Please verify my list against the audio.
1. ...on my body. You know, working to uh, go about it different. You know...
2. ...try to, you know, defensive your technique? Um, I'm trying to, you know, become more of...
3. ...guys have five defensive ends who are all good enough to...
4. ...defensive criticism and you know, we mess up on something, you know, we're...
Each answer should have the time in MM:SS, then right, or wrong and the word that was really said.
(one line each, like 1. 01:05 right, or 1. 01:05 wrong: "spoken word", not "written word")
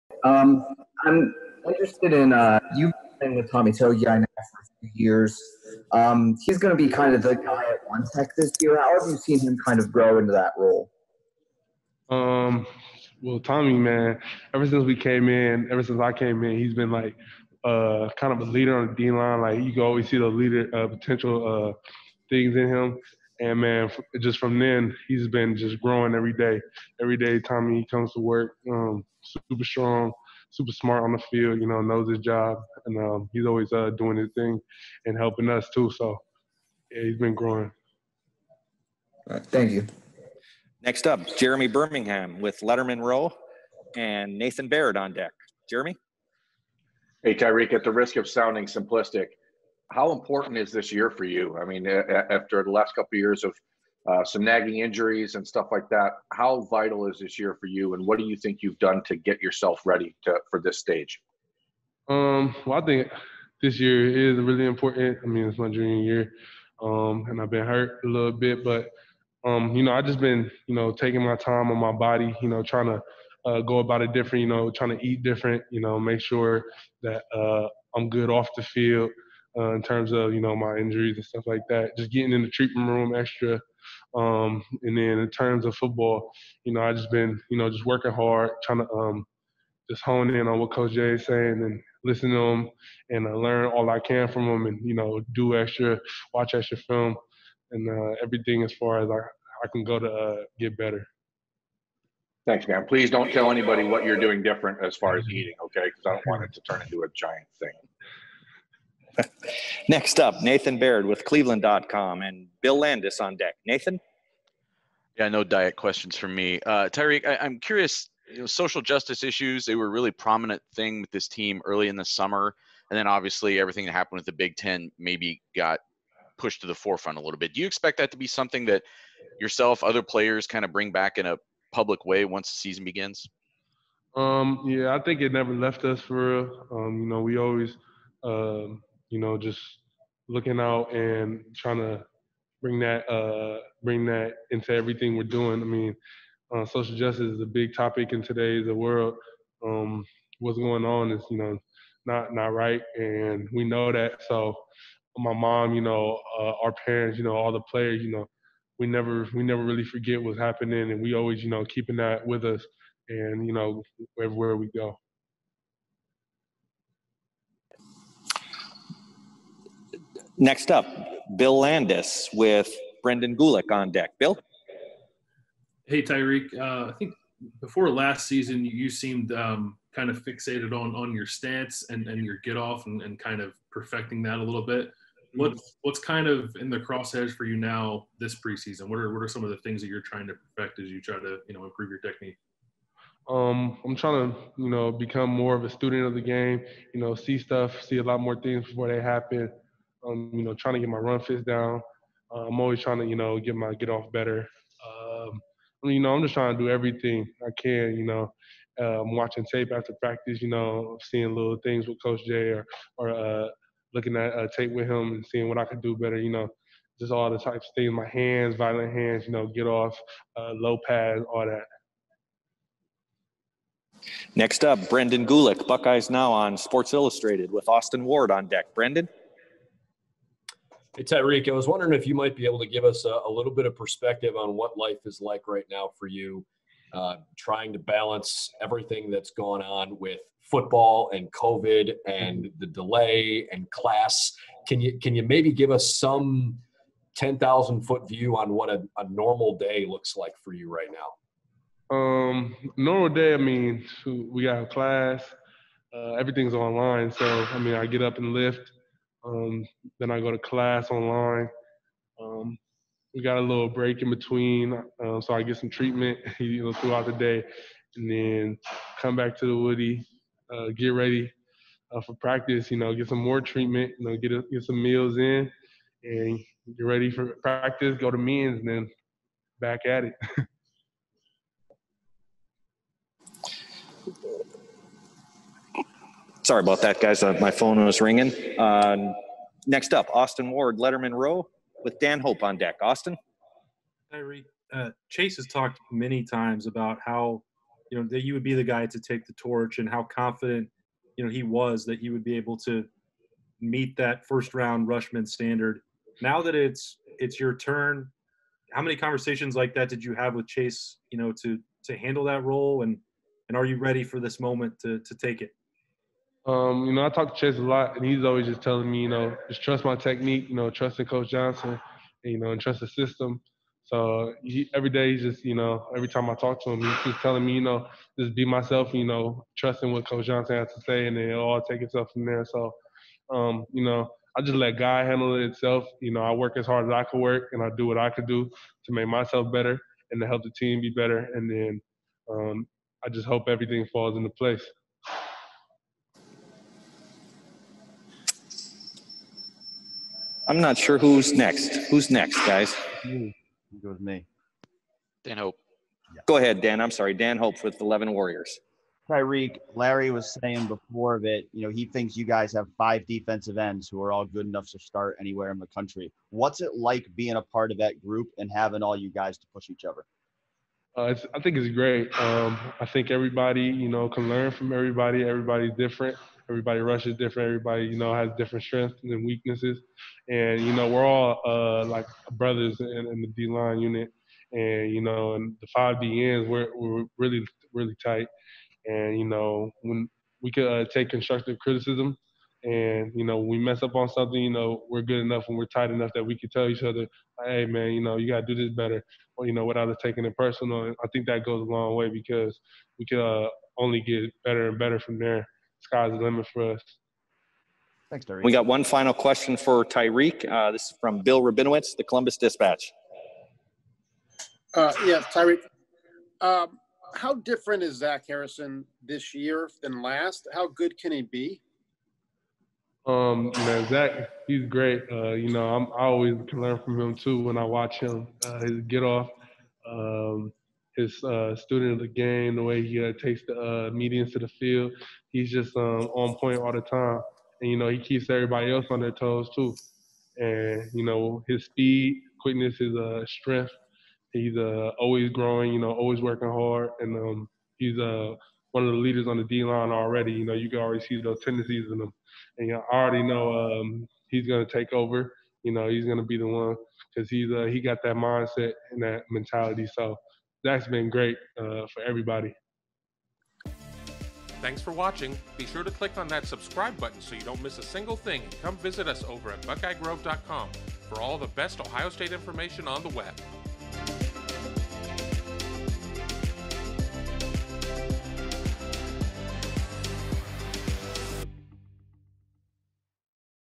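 1. 01:11 wrong: "trying", not "working"
2. 03:11 wrong: "improve", not "defensive"
3. 06:02 right
4. 06:31 wrong: "constructive", not "defensive".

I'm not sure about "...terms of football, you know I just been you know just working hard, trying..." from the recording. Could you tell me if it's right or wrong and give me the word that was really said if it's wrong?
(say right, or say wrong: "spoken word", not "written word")
right.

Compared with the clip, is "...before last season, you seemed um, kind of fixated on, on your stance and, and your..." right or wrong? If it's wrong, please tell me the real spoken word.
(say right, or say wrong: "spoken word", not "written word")
right.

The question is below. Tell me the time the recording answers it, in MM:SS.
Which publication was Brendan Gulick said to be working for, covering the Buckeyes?
03:46.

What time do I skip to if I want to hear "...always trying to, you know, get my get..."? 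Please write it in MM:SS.
03:22.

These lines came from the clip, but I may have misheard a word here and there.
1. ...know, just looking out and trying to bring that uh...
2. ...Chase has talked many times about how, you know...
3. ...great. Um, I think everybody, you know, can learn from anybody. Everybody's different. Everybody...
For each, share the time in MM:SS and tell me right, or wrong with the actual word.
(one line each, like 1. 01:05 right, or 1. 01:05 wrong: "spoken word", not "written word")
1. 02:19 right
2. 04:55 right
3. 06:11 wrong: "everybody", not "anybody".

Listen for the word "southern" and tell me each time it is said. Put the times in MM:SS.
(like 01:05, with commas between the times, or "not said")
not said.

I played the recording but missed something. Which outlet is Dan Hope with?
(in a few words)
11 Warriors.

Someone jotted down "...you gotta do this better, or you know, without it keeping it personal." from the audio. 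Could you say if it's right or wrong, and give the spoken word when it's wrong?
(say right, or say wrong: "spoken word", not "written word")
wrong: "taking", not "keeping".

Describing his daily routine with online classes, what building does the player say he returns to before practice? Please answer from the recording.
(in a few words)
the Woody.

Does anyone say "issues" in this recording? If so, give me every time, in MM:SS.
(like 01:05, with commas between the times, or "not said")
01:59.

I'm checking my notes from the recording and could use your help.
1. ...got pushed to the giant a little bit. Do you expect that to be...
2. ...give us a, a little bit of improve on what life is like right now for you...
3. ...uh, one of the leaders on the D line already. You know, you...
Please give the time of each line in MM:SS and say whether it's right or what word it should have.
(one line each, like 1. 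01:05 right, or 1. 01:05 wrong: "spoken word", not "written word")
1. 02:05 wrong: "forefront", not "giant"
2. 03:52 wrong: "perspective", not "improve"
3. 07:27 right.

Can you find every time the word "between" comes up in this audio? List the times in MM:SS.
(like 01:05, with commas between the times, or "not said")
04:24.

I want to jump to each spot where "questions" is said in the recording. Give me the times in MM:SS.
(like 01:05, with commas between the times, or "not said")
01:55, 06:49.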